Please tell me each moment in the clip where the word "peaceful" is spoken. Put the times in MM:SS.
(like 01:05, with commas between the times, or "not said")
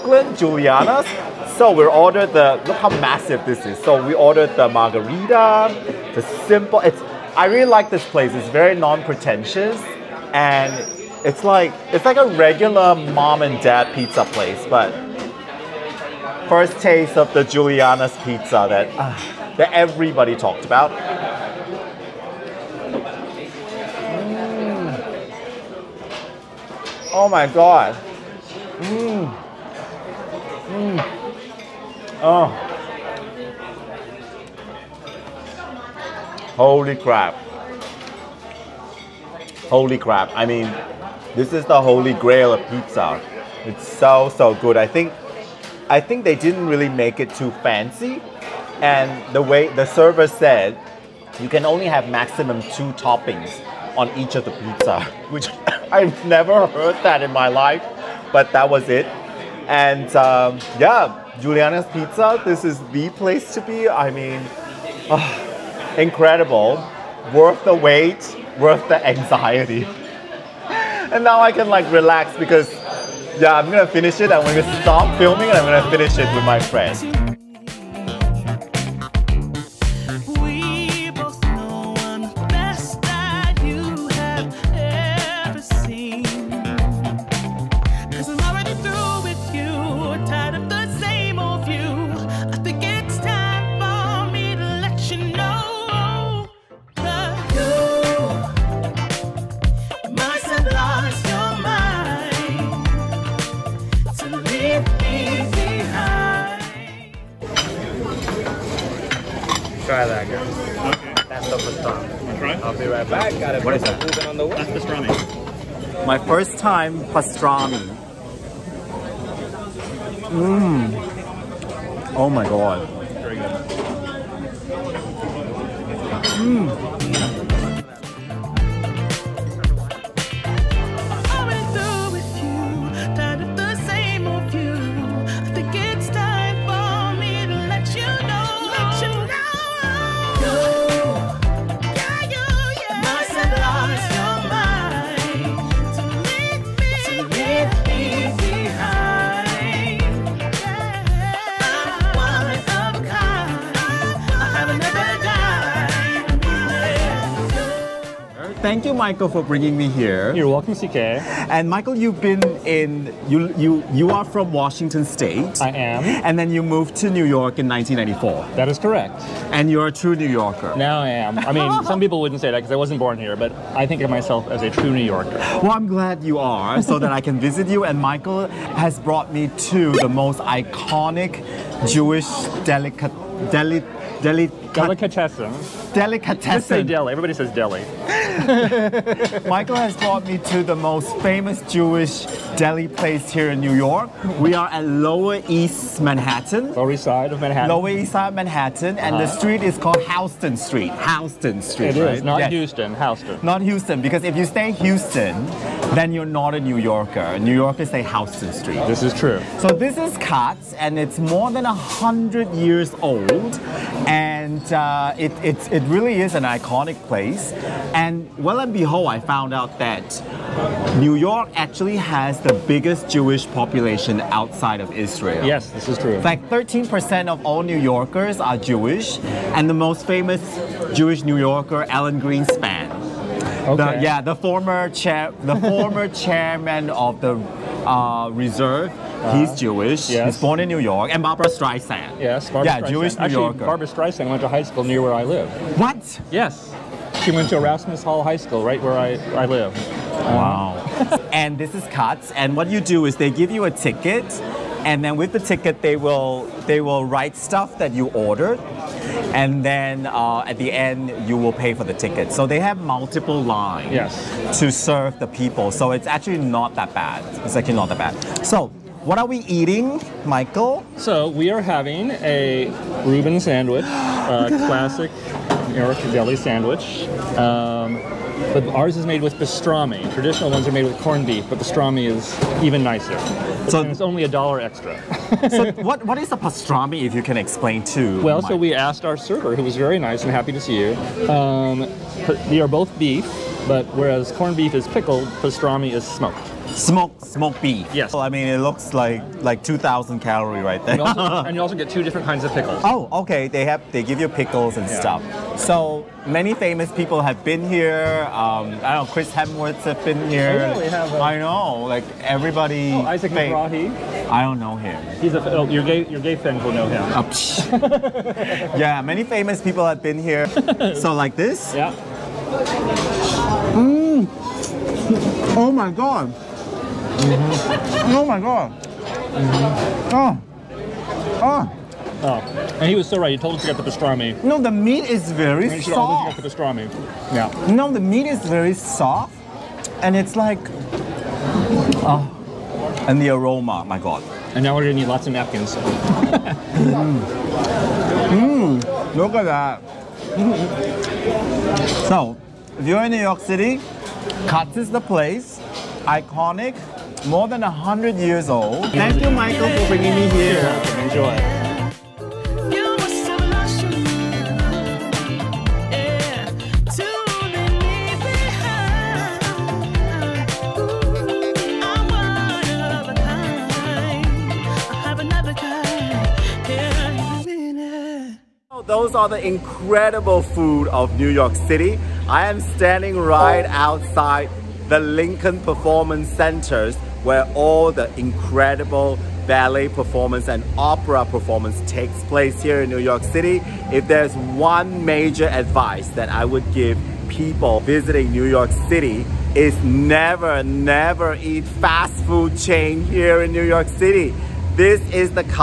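not said.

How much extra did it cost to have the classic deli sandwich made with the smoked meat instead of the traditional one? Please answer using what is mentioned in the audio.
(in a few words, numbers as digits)
$1.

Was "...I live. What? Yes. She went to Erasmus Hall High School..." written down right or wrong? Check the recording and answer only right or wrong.
right.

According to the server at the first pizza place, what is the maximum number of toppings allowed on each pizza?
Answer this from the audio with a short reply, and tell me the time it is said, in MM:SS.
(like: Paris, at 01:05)
2, at 00:52.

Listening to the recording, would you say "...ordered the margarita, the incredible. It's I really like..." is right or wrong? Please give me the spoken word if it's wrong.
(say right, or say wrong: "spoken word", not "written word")
wrong: "simple", not "incredible".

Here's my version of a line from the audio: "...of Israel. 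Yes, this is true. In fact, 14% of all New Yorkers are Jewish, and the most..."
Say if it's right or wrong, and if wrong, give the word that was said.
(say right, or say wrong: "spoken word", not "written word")
wrong: "13", not "14".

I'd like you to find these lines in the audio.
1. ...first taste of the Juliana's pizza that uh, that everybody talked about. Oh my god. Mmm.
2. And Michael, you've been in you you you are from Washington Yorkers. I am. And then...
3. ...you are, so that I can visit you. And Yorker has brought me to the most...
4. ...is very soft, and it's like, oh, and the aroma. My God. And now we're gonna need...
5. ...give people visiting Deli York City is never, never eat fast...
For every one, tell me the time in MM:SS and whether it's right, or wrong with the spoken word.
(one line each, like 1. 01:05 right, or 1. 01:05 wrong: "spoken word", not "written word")
1. 00:16 right
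2. 02:41 wrong: "State", not "Yorkers"
3. 02:56 wrong: "Michael", not "Yorker"
4. 05:38 right
5. 06:36 wrong: "New", not "Deli".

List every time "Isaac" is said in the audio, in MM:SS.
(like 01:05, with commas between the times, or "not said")
05:13.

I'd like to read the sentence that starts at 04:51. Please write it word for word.
Um, are both beef, but whereas corned beef is pickled, pastrami is smoked.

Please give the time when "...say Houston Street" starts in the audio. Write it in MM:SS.
03:27.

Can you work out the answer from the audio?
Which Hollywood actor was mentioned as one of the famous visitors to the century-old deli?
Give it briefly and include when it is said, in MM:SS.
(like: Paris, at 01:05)
Chris Hemsworth, at 05:09.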